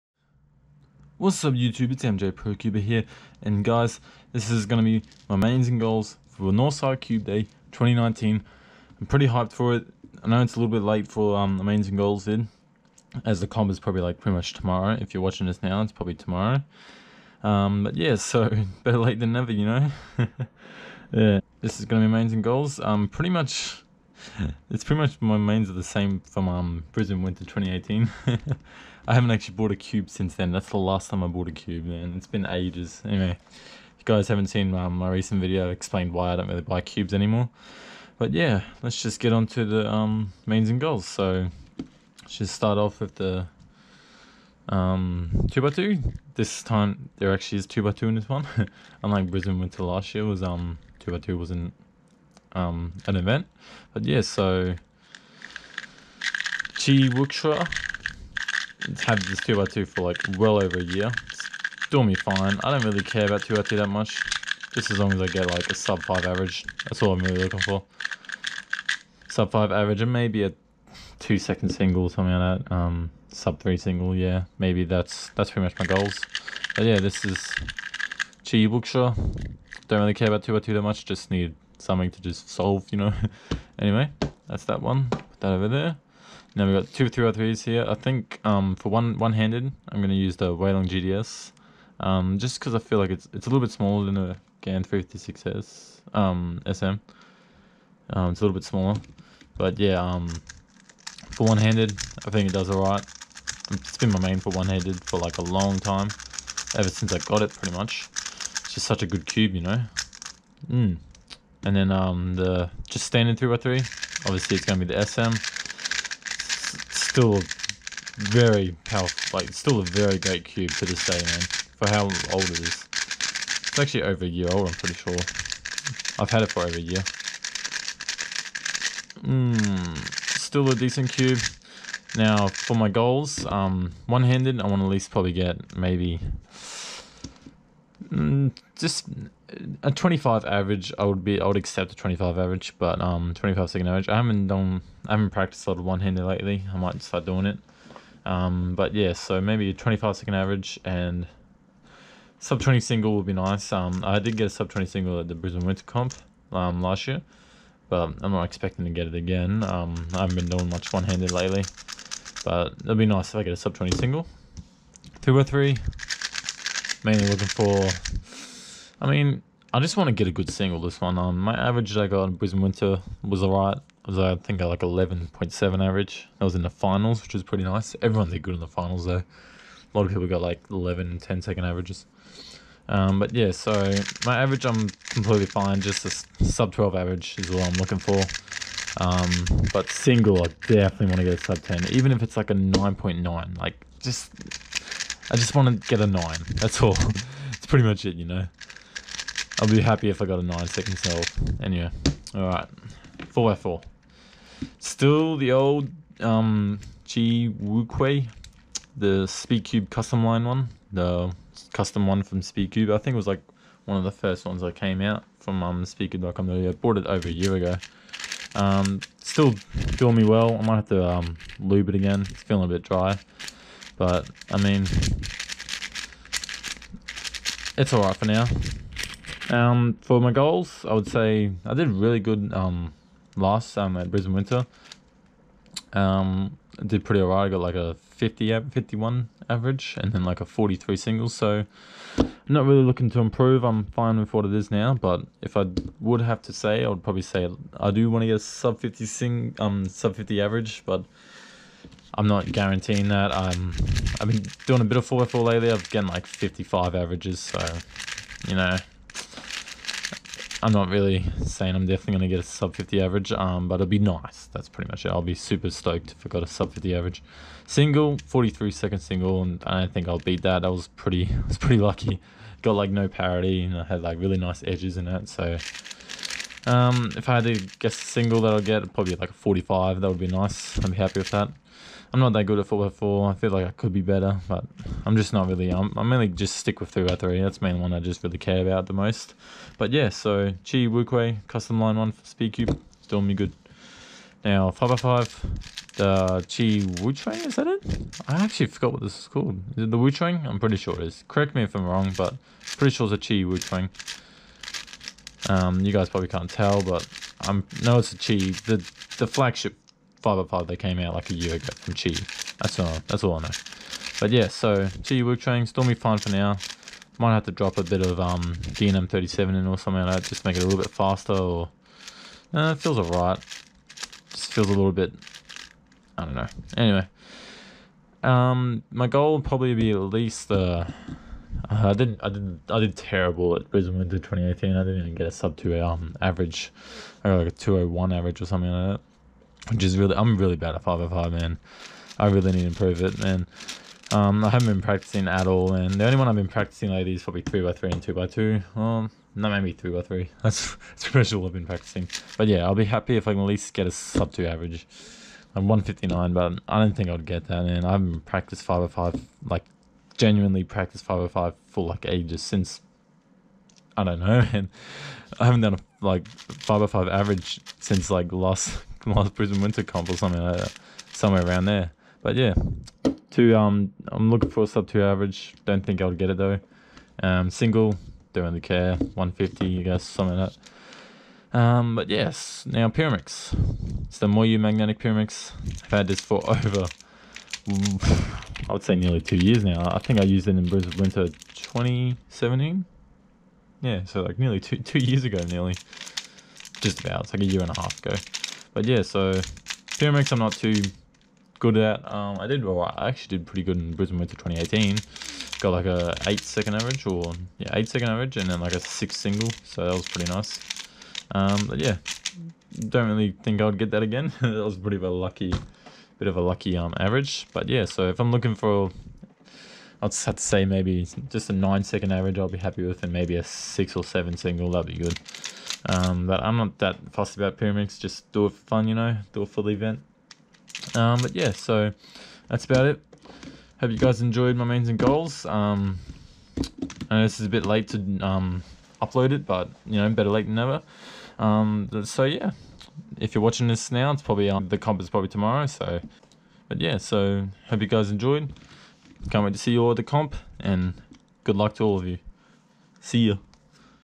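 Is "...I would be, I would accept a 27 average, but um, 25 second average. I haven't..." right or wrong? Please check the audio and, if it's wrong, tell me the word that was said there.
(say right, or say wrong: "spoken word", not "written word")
wrong: "25", not "27".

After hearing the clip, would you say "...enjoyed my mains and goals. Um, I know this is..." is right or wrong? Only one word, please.
right.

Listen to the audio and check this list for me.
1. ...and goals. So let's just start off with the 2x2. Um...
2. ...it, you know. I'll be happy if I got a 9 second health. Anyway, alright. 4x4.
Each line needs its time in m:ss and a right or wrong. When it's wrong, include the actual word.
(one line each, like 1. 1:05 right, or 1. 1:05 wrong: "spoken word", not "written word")
1. 0:40 right
2. 3:18 right.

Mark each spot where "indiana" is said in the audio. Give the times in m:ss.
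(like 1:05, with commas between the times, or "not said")
not said.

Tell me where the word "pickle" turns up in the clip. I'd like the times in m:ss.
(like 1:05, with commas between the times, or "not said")
not said.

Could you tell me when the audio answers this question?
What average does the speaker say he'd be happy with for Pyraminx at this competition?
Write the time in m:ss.
7:01.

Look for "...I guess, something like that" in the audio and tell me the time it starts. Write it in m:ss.
6:19.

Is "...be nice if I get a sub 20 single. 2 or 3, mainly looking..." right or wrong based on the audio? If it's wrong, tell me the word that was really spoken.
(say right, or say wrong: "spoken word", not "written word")
right.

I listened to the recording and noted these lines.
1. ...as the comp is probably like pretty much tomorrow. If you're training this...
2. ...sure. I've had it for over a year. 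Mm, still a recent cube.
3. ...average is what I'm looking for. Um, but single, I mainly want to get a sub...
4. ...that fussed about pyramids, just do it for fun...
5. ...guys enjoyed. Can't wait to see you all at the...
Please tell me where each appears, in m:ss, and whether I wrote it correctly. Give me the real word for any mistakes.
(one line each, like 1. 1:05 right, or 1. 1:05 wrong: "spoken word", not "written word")
1. 0:13 wrong: "watching", not "training"
2. 2:04 wrong: "decent", not "recent"
3. 3:06 wrong: "definitely", not "mainly"
4. 7:06 right
5. 7:27 right.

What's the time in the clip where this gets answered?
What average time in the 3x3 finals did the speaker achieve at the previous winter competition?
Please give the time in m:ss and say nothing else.
2:54.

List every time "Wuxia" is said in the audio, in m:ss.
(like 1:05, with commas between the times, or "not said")
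0:57, 1:18.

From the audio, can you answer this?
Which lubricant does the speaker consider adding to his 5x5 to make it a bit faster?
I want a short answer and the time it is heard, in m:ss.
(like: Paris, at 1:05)
DNM 37, at 5:18.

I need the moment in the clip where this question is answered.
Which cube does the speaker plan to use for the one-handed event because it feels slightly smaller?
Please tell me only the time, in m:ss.
1:30.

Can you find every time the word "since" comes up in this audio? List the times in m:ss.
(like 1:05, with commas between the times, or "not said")
0:30, 1:46, 6:02, 6:07.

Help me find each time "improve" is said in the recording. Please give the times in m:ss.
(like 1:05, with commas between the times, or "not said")
4:03, 5:42.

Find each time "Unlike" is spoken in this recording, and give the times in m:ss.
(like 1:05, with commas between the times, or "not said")
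0:49.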